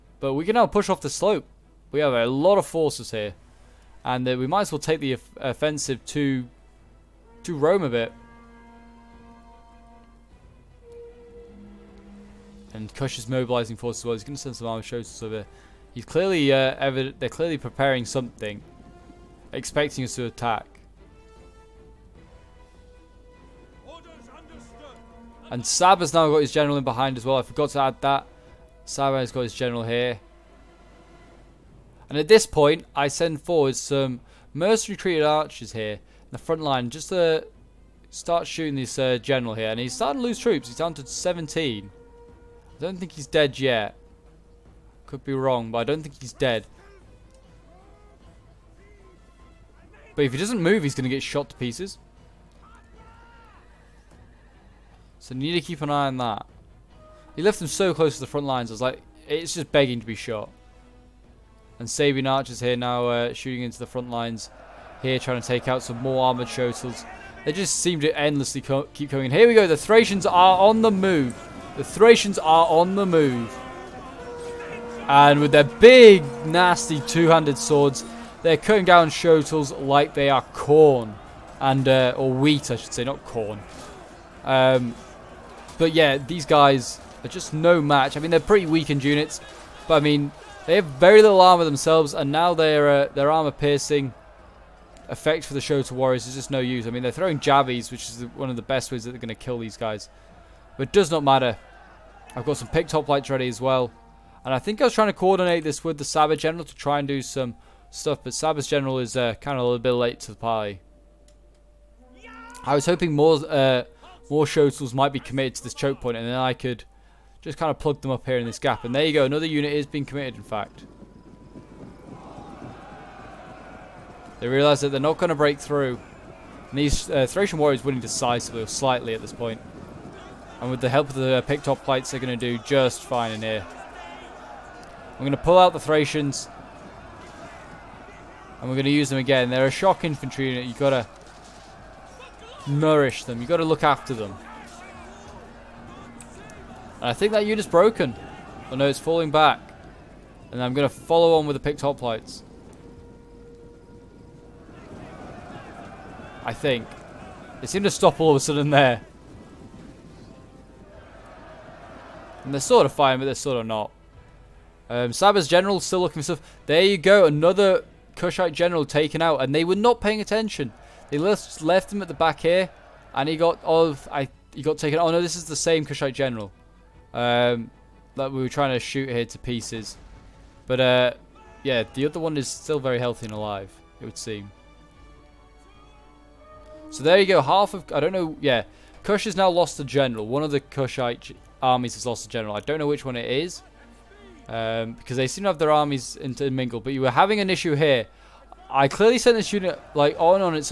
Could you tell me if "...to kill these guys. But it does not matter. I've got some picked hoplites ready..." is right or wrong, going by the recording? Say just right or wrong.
right.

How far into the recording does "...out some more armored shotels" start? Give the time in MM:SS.
01:05.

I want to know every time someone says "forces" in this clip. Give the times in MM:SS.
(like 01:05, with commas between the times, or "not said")
00:02, 00:13.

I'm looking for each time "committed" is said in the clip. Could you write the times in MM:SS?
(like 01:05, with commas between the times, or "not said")
01:55, 02:00.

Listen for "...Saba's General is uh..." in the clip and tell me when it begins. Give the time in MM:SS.
01:48.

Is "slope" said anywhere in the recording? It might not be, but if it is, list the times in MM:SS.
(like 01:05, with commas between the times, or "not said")
00:01.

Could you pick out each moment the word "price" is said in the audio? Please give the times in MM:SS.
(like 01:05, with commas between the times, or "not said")
not said.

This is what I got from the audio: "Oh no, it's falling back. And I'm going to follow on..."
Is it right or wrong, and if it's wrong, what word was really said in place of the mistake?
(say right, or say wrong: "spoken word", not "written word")
right.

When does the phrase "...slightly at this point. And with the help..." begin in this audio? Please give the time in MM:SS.
02:08.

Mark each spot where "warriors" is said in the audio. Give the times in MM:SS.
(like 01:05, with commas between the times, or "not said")
01:35, 02:07.